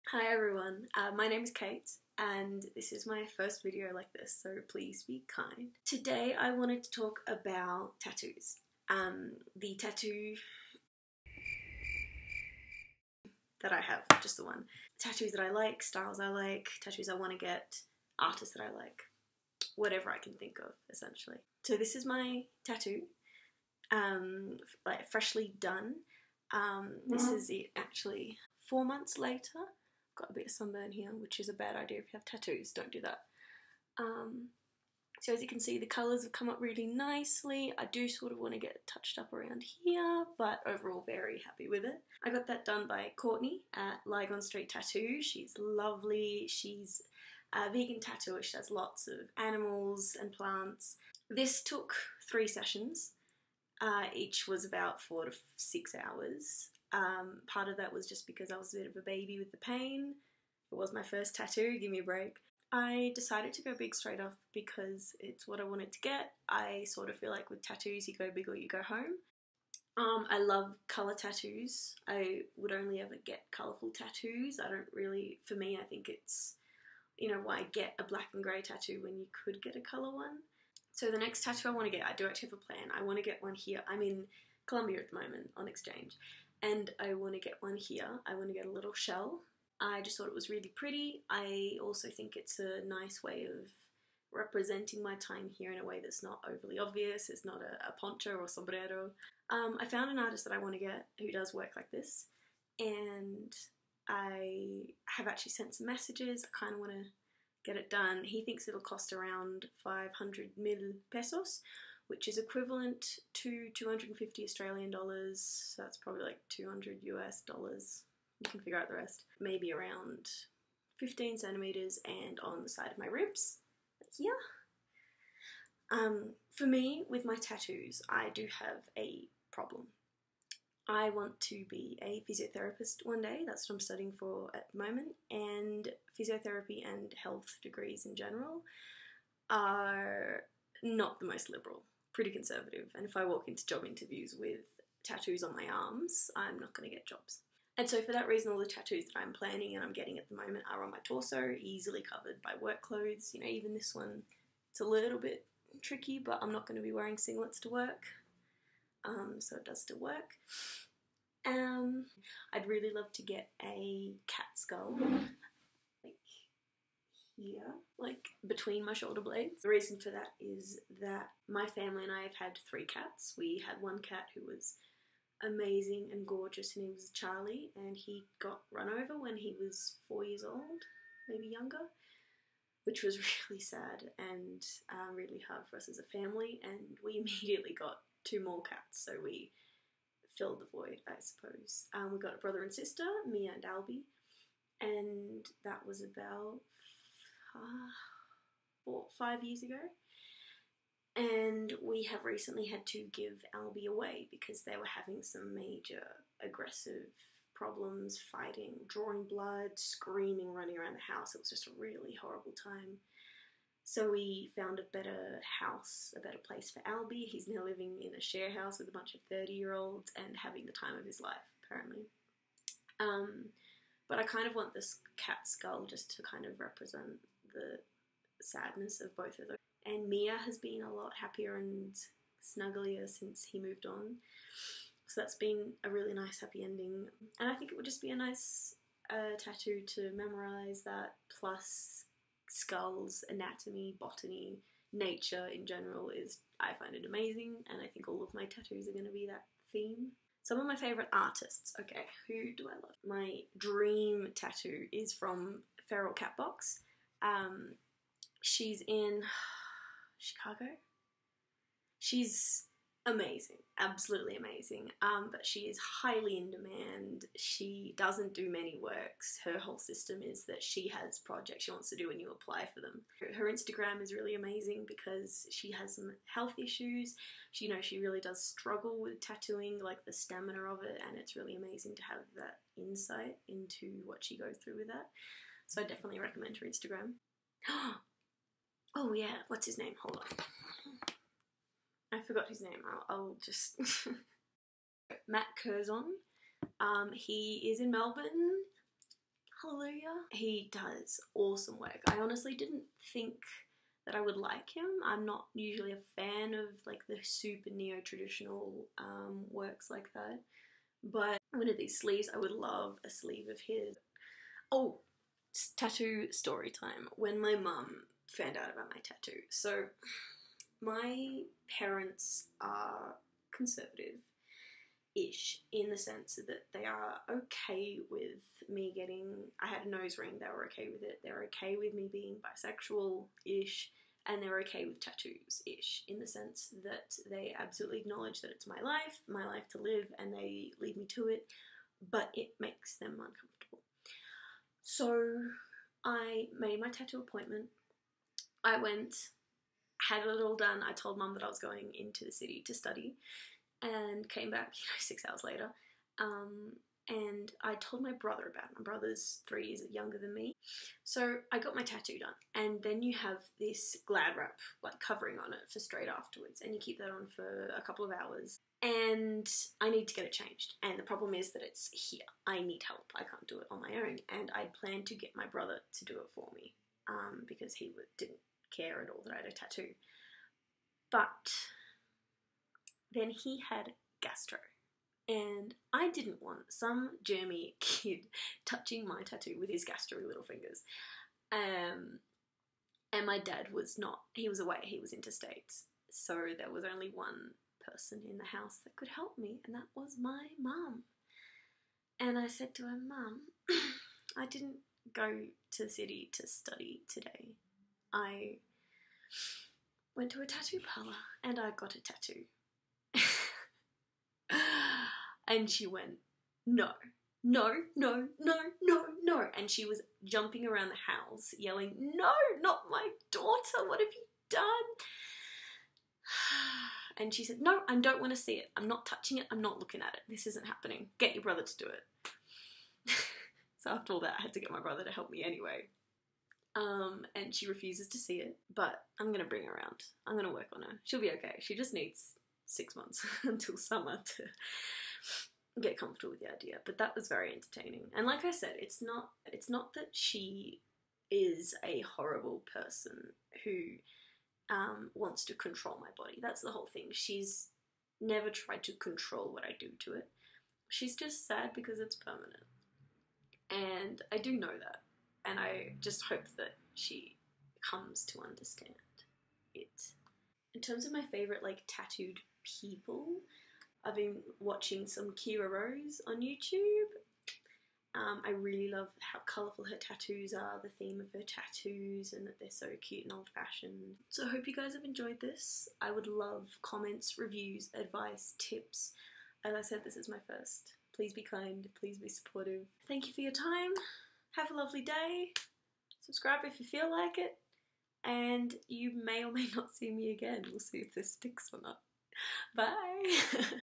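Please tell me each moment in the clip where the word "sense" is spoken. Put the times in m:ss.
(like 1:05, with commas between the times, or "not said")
5:25, 5:36.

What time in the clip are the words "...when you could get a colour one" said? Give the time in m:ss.
1:19.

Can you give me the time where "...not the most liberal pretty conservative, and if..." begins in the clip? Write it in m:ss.
2:20.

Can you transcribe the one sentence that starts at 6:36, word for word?
So there was only one person in the house that could help me, and that was my mum.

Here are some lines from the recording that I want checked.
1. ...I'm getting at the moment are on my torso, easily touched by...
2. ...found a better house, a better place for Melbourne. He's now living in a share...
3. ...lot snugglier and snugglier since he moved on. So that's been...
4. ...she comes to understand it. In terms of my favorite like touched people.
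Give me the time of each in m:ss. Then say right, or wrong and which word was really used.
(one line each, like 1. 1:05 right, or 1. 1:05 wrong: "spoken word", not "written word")
1. 2:29 wrong: "covered", not "touched"
2. 3:34 wrong: "Albie", not "Melbourne"
3. 3:50 wrong: "happier", not "snugglier"
4. 7:46 wrong: "tattooed", not "touched".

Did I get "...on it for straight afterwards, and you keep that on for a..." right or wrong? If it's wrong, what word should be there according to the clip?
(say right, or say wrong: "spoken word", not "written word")
right.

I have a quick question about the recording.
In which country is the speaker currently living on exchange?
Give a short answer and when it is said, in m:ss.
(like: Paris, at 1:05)
Colombia, at 1:24.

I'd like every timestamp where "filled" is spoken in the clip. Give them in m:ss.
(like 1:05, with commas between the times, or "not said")
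3:10.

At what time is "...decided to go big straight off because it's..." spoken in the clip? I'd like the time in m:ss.
1:03.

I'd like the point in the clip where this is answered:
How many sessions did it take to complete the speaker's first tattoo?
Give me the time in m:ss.
0:52.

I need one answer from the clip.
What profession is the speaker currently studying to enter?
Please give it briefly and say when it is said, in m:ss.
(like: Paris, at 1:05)
Physiotherapist, at 2:12.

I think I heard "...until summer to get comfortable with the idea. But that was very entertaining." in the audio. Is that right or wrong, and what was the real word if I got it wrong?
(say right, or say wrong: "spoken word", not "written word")
right.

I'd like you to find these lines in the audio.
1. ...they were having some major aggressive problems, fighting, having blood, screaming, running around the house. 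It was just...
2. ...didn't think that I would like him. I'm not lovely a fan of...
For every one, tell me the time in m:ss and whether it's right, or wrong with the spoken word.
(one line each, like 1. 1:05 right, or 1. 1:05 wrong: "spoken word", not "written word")
1. 3:24 wrong: "drawing", not "having"
2. 5:02 wrong: "usually", not "lovely".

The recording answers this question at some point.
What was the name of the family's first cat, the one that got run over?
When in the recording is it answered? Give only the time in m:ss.
2:57.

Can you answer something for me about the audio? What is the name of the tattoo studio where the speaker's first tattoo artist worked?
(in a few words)
Lygon Street Tattoo.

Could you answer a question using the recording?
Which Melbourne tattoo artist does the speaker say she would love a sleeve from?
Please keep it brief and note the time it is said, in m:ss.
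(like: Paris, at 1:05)
Matt Curzon, at 4:55.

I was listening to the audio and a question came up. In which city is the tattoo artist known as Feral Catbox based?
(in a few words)
Chicago.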